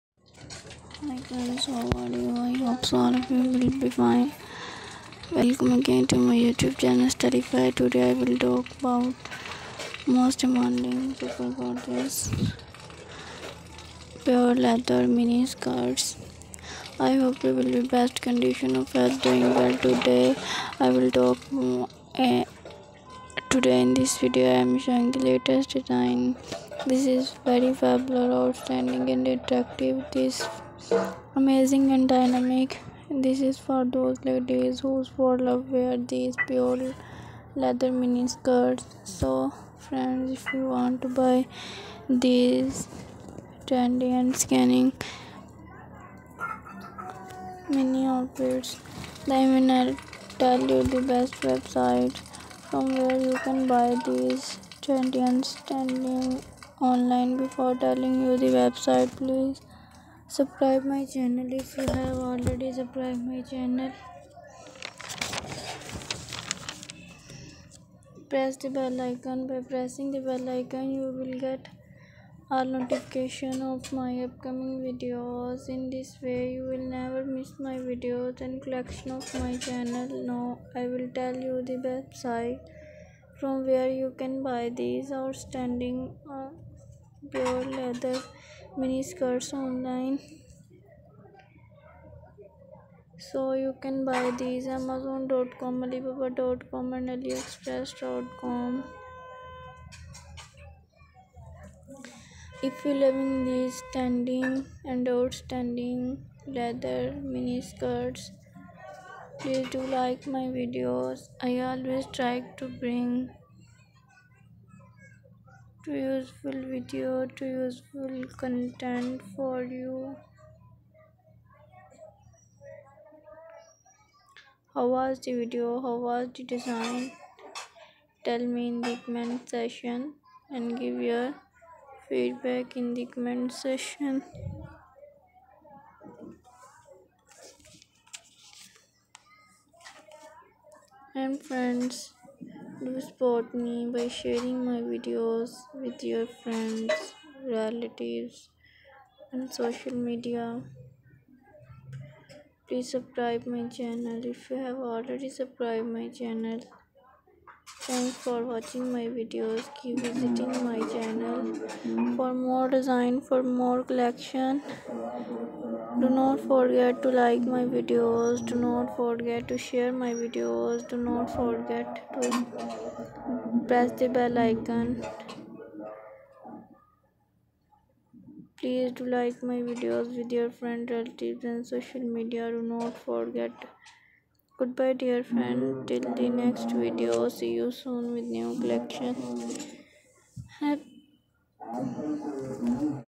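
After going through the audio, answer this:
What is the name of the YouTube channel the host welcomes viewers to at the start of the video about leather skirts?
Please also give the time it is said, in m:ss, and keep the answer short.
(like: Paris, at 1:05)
Styleify, at 0:07.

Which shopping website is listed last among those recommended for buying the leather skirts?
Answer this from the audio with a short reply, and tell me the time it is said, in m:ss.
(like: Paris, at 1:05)
aliexpress.com, at 1:37.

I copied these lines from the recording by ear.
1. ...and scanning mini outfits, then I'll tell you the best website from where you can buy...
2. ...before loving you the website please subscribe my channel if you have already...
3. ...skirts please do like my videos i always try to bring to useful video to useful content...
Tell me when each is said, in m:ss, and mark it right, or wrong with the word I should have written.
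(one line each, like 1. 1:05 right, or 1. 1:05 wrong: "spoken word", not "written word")
1. 0:44 right
2. 0:57 wrong: "telling", not "loving"
3. 1:47 right.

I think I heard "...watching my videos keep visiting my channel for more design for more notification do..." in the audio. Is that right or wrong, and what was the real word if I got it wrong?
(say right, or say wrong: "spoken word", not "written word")
wrong: "collection", not "notification".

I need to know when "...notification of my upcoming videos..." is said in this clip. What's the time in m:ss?
1:12.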